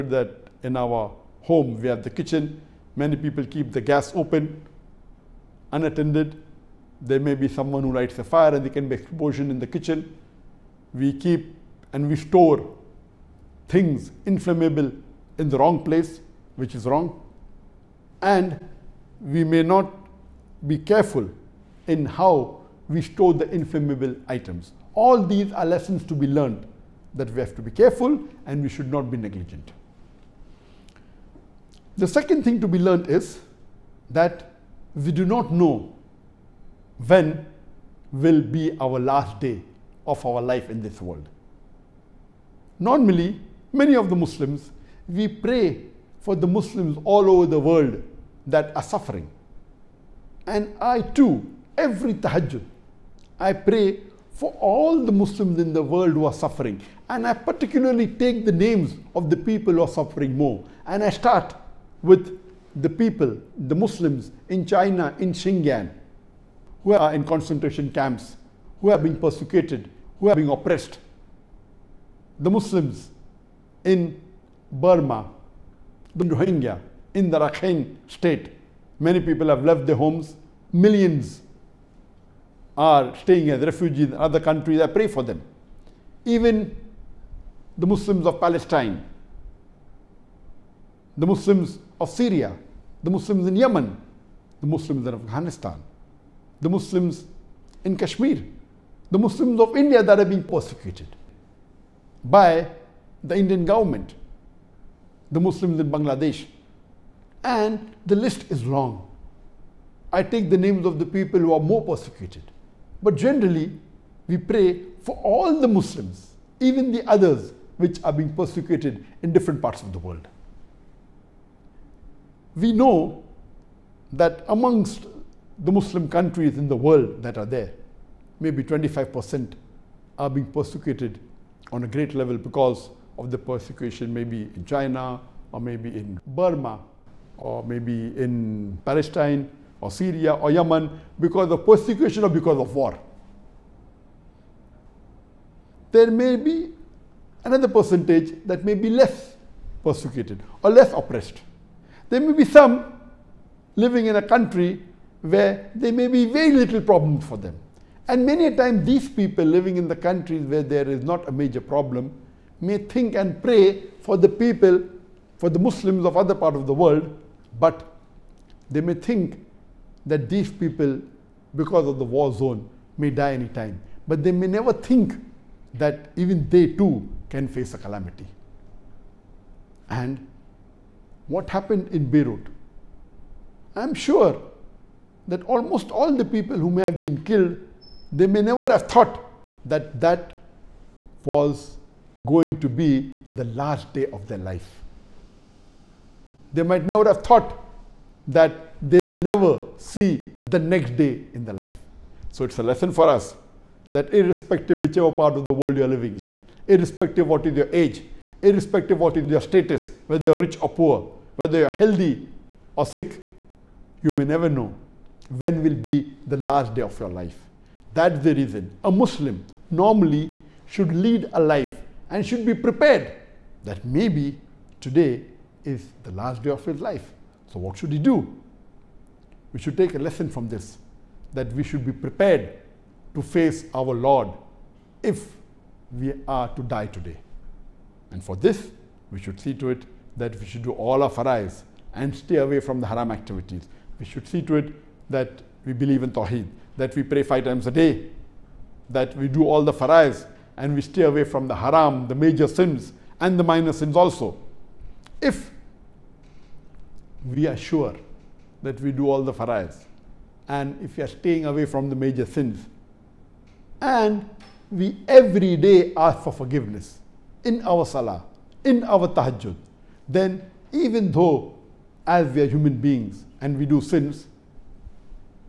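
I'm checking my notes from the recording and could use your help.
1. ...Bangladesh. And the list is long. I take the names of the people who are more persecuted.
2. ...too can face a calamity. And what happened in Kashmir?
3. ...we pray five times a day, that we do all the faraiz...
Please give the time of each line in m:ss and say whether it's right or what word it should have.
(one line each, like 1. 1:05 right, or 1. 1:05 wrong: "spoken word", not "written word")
1. 1:45 right
2. 2:56 wrong: "Beirut", not "Kashmir"
3. 4:06 right.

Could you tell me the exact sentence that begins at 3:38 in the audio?
A Muslim normally should lead a life and should be prepared that maybe today is the last day of his life.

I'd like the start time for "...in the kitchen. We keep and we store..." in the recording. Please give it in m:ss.
0:09.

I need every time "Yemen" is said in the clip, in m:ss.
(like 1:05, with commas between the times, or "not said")
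1:33, 2:20.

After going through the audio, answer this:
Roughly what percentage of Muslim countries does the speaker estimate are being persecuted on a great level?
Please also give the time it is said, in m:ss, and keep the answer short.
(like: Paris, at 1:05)
25%, at 2:08.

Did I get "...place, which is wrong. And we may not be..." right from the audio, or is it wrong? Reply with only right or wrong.
right.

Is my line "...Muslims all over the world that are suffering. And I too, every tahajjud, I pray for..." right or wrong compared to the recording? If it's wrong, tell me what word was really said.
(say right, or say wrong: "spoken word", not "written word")
right.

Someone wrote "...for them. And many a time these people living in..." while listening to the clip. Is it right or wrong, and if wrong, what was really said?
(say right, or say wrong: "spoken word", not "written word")
right.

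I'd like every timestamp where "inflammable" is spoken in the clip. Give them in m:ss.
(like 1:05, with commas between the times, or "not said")
0:14, 0:23.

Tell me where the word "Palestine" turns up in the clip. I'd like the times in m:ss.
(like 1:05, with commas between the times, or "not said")
1:28, 2:18.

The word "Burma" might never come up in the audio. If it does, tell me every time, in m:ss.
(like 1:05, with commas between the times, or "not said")
1:14, 2:16.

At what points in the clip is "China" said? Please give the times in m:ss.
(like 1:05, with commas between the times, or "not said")
1:04, 2:14.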